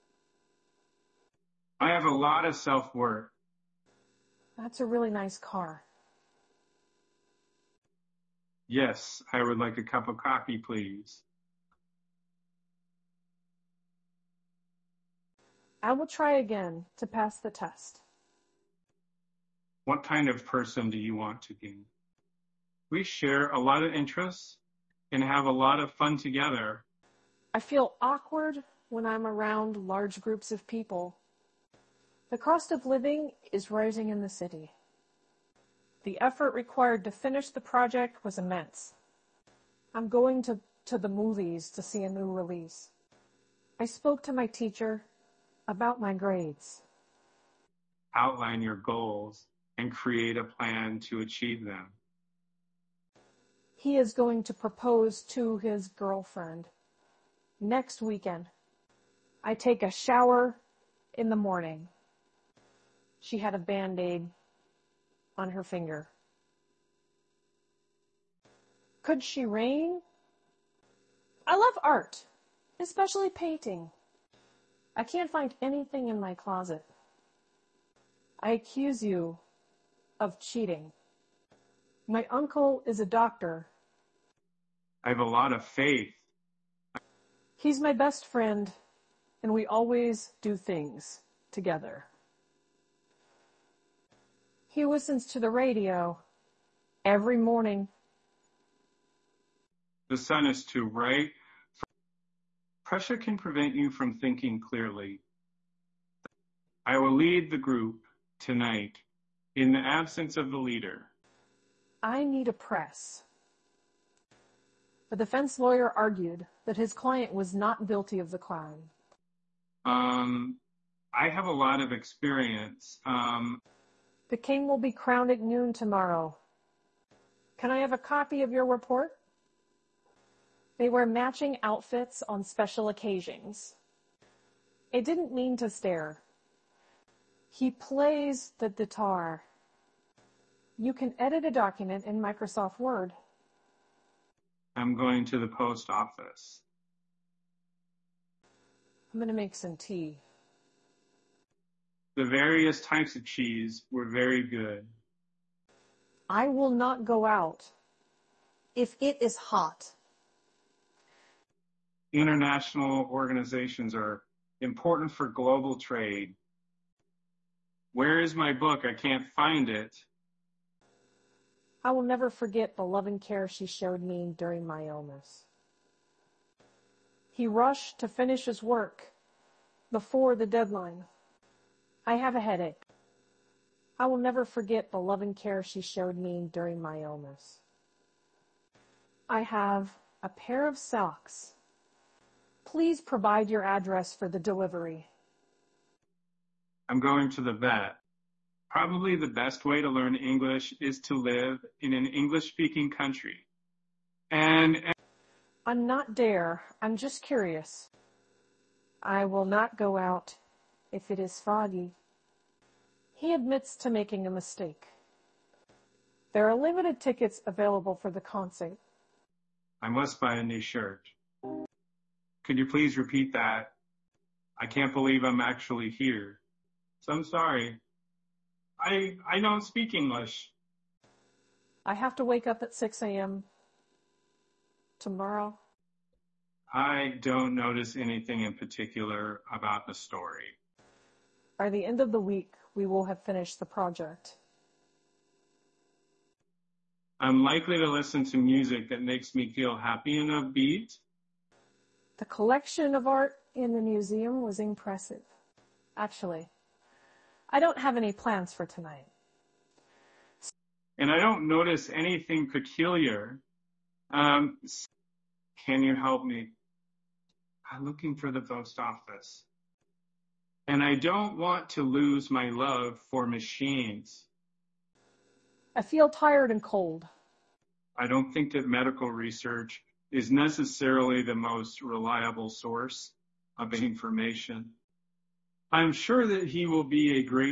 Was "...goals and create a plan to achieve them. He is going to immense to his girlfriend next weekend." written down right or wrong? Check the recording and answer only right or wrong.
wrong.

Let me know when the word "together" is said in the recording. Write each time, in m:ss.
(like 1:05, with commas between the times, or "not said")
0:26, 1:31.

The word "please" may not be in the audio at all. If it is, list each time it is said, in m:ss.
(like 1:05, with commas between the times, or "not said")
0:10, 3:12, 3:42.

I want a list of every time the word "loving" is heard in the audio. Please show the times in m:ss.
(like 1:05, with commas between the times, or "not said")
2:52, 3:04.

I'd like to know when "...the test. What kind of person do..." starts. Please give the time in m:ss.
0:17.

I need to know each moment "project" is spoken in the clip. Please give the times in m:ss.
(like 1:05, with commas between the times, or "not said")
0:37, 4:03.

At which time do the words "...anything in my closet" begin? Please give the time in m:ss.
1:15.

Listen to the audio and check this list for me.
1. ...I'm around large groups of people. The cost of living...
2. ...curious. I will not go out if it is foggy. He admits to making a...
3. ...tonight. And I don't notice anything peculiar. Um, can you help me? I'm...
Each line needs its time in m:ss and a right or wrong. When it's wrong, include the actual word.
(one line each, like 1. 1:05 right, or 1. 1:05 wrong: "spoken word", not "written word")
1. 0:29 right
2. 3:27 right
3. 4:18 right.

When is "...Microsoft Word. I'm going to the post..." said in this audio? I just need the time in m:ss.
2:22.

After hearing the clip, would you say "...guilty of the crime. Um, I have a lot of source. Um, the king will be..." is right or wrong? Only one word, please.
wrong.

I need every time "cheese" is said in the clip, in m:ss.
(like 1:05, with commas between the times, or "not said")
2:33.